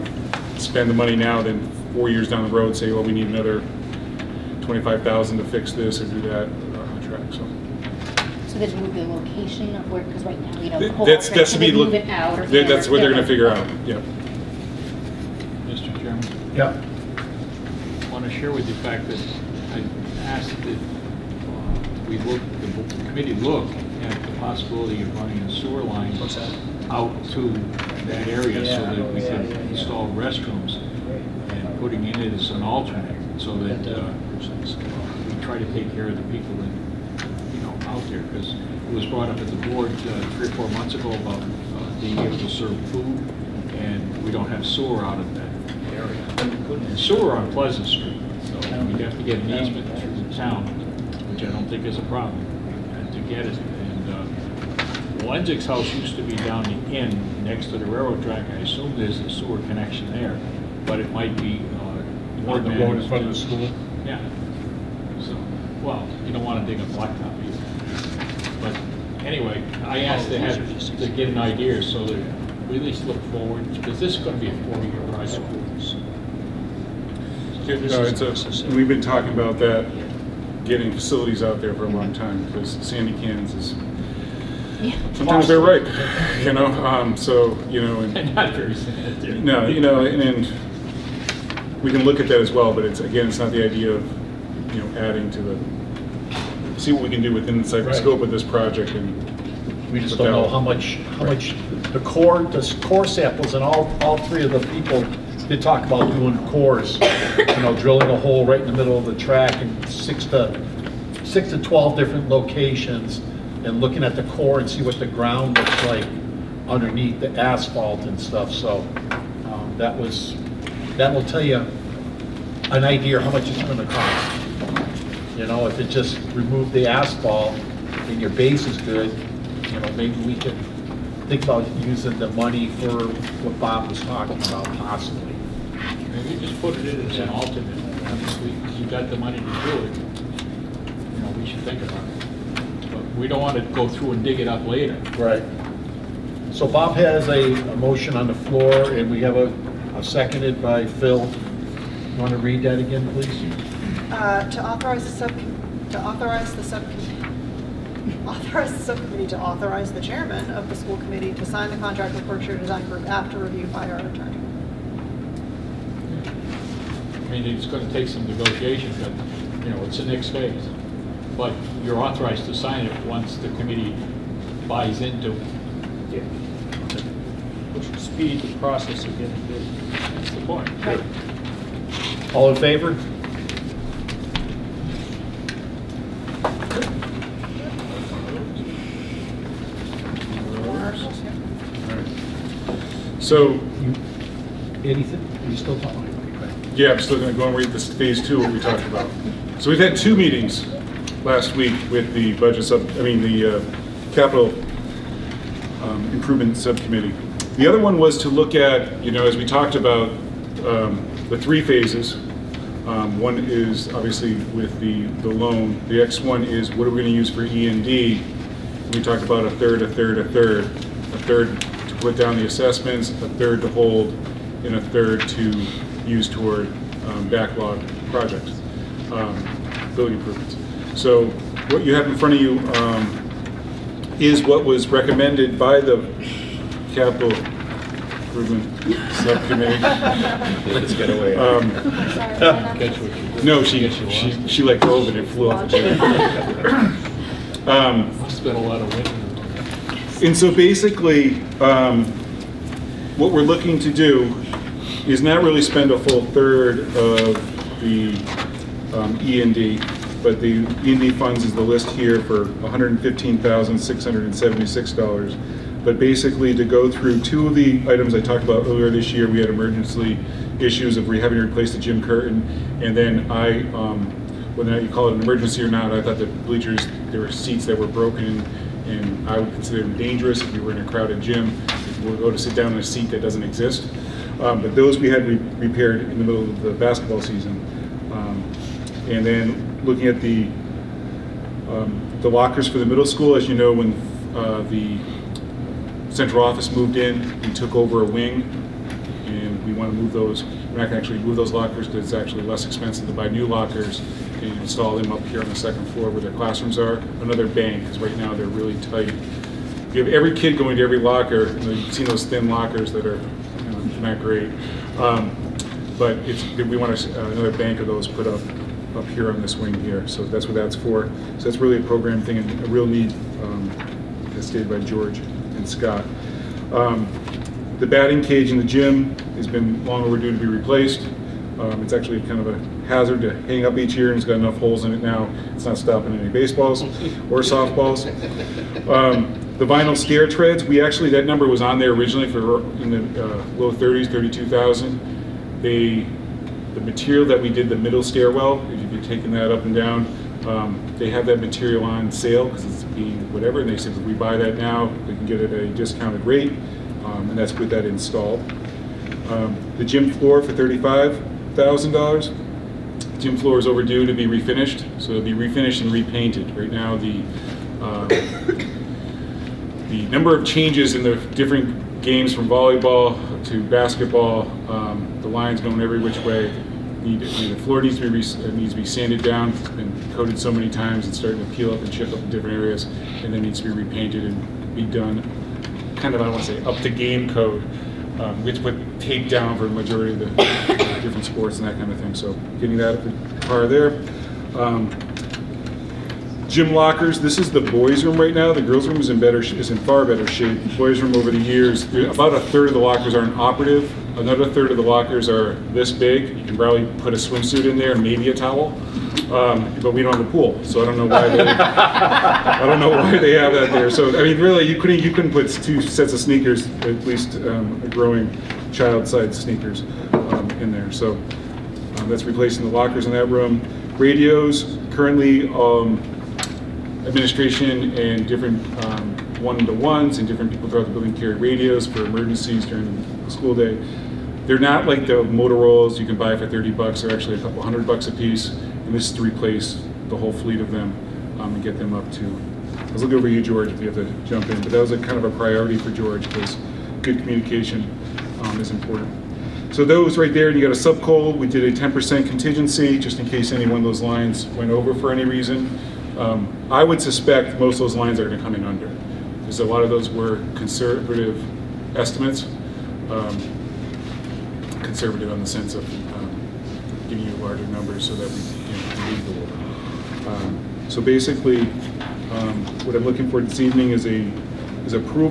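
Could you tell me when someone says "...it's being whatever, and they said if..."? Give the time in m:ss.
5:52.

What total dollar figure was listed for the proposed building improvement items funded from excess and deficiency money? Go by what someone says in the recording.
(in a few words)
$115,676.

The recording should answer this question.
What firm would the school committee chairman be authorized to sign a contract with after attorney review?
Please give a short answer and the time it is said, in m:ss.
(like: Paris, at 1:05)
Berkshire Design Group, at 2:42.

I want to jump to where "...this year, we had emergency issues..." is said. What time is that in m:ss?
4:28.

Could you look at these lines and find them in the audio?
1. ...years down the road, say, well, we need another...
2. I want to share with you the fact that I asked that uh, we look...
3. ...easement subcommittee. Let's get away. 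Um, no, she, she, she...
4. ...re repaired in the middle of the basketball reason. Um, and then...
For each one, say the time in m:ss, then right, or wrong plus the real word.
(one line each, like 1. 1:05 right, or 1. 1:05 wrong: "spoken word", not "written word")
1. 0:02 right
2. 0:18 right
3. 3:58 wrong: "improvement", not "easement"
4. 4:45 wrong: "season", not "reason".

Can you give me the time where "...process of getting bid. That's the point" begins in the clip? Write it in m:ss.
2:58.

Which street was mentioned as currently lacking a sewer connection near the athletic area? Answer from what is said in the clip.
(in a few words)
Pleasant Street.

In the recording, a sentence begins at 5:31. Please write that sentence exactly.
Um, it's actually kind of a hazard to hang up each year, and it's got enough holes in it now.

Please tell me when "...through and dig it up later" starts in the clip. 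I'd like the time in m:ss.
2:23.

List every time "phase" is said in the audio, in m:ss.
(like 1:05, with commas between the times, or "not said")
2:50, 3:17, 3:31.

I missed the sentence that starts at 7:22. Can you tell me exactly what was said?
I was looking over you, George, if you have to jump in.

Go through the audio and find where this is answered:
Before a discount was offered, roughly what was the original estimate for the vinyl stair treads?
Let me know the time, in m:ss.
5:44.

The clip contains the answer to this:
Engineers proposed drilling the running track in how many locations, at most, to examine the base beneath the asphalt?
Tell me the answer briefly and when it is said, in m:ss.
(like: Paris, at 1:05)
12, at 1:51.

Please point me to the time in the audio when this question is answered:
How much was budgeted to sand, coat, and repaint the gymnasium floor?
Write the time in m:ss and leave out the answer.
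6:00.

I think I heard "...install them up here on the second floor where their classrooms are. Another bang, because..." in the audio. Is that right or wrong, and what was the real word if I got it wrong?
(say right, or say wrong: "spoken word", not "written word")
right.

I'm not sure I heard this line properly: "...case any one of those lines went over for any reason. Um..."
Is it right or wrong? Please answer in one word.
right.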